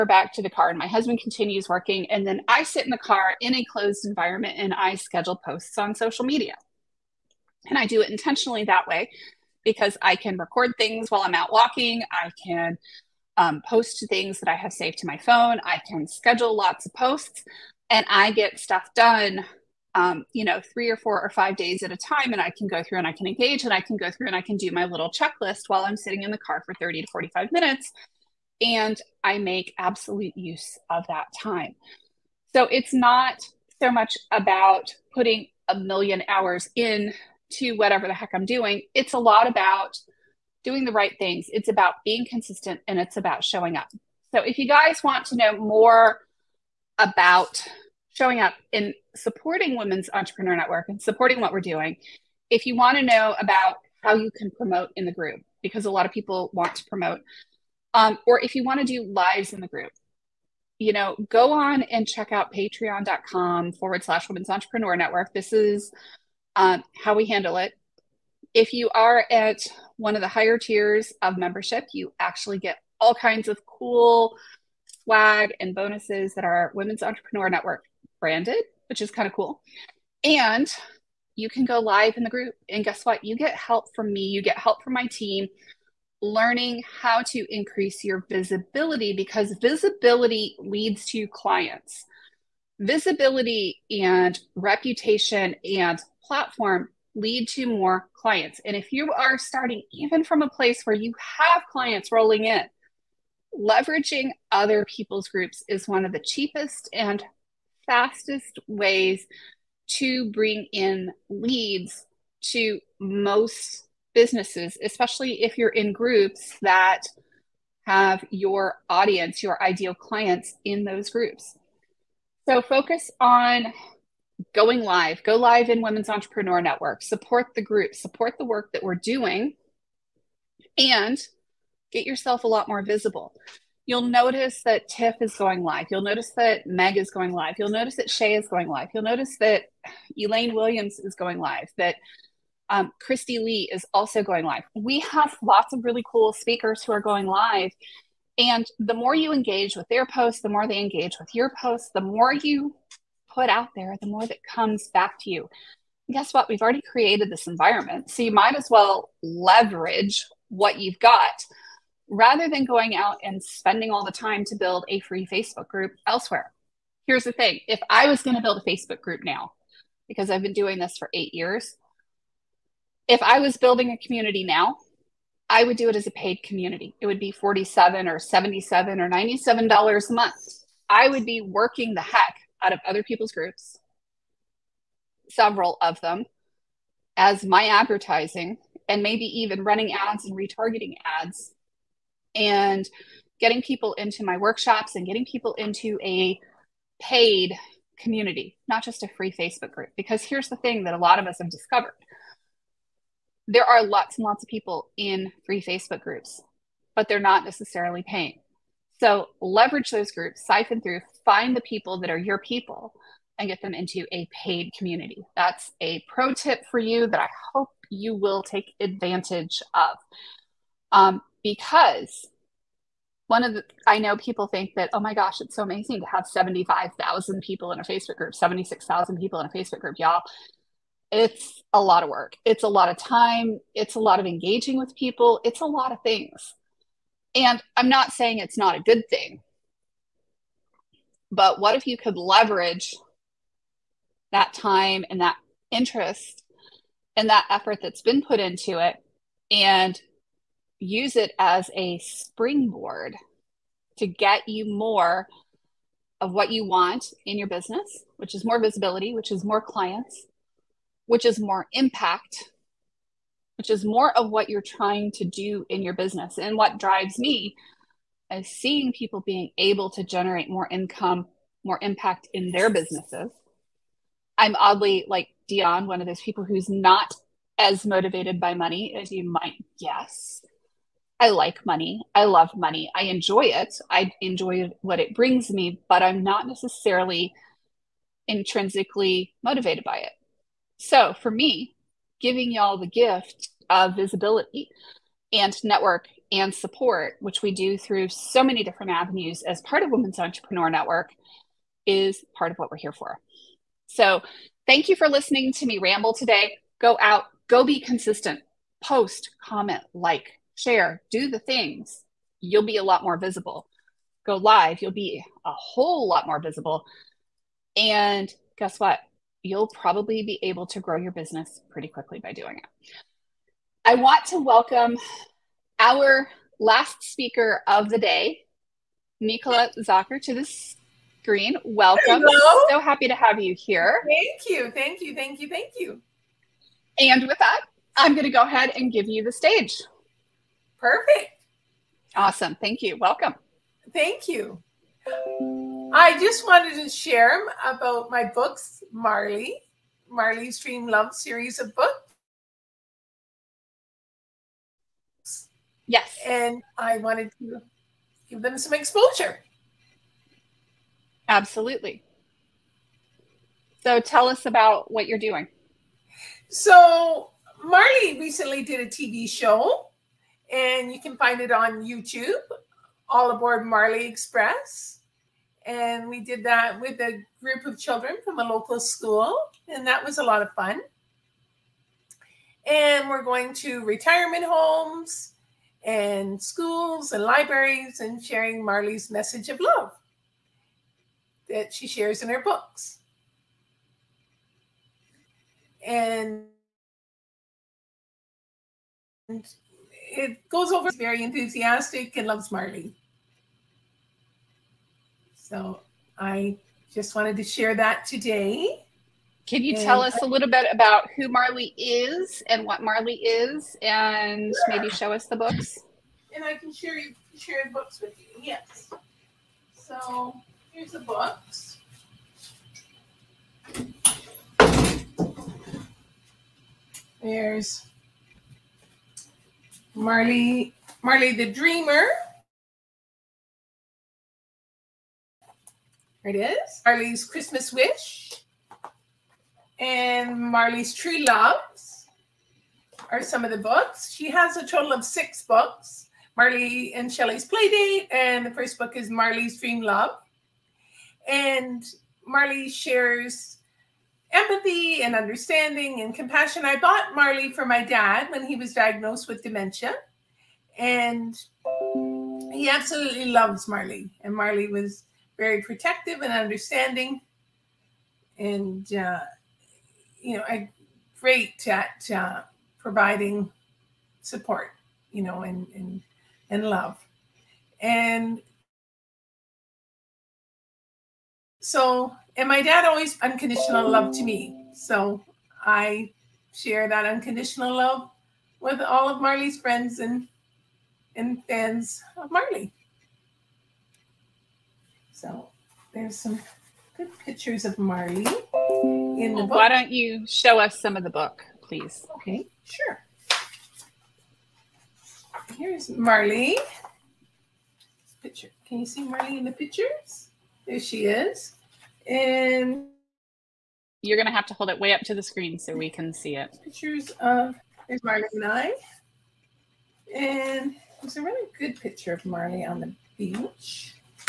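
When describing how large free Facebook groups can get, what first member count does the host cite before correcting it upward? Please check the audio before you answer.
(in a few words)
75,000.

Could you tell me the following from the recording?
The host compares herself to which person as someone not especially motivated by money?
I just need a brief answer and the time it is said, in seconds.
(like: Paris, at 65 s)
Dion, at 275 s.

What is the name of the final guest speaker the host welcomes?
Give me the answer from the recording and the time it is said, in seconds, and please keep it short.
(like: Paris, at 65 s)
Nicola Zocker, at 329 s.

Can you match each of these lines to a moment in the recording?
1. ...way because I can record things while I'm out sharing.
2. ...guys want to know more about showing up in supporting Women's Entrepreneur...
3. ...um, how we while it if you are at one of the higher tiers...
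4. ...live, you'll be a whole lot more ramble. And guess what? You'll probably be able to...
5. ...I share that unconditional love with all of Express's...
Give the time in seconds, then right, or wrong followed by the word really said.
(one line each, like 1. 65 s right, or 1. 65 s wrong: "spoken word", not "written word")
1. 8 s wrong: "walking", not "sharing"
2. 44 s right
3. 66 s wrong: "handle", not "while"
4. 314 s wrong: "visible", not "ramble"
5. 485 s wrong: "Marley", not "Express".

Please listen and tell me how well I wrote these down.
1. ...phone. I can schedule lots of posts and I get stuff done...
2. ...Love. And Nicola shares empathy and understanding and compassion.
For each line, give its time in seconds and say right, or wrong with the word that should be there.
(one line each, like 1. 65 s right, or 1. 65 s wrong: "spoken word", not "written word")
1. 15 s right
2. 449 s wrong: "Marley", not "Nicola".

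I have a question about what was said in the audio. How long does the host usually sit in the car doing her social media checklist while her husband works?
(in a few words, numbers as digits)
30 to 45 minutes.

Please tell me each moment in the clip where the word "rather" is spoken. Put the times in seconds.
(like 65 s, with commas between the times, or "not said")
162 s.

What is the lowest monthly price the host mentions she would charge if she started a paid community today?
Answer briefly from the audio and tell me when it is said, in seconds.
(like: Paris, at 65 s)
$47, at 177 s.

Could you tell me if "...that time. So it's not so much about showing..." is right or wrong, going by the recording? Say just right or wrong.
wrong.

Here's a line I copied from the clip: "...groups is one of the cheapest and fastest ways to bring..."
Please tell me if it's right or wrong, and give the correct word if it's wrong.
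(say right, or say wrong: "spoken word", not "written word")
right.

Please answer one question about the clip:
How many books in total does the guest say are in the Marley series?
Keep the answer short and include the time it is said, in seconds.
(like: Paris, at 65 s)
6, at 445 s.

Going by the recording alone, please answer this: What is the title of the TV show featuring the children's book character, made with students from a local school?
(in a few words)
All Aboard Marley Express.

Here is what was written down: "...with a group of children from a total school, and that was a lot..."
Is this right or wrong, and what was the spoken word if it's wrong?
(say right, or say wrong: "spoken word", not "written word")
wrong: "local", not "total".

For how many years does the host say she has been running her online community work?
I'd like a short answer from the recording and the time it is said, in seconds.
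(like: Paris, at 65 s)
8 years, at 171 s.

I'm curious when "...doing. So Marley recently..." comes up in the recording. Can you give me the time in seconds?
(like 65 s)
365 s.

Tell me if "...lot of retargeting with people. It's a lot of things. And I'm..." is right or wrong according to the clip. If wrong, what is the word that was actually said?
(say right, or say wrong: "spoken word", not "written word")
wrong: "engaging", not "retargeting".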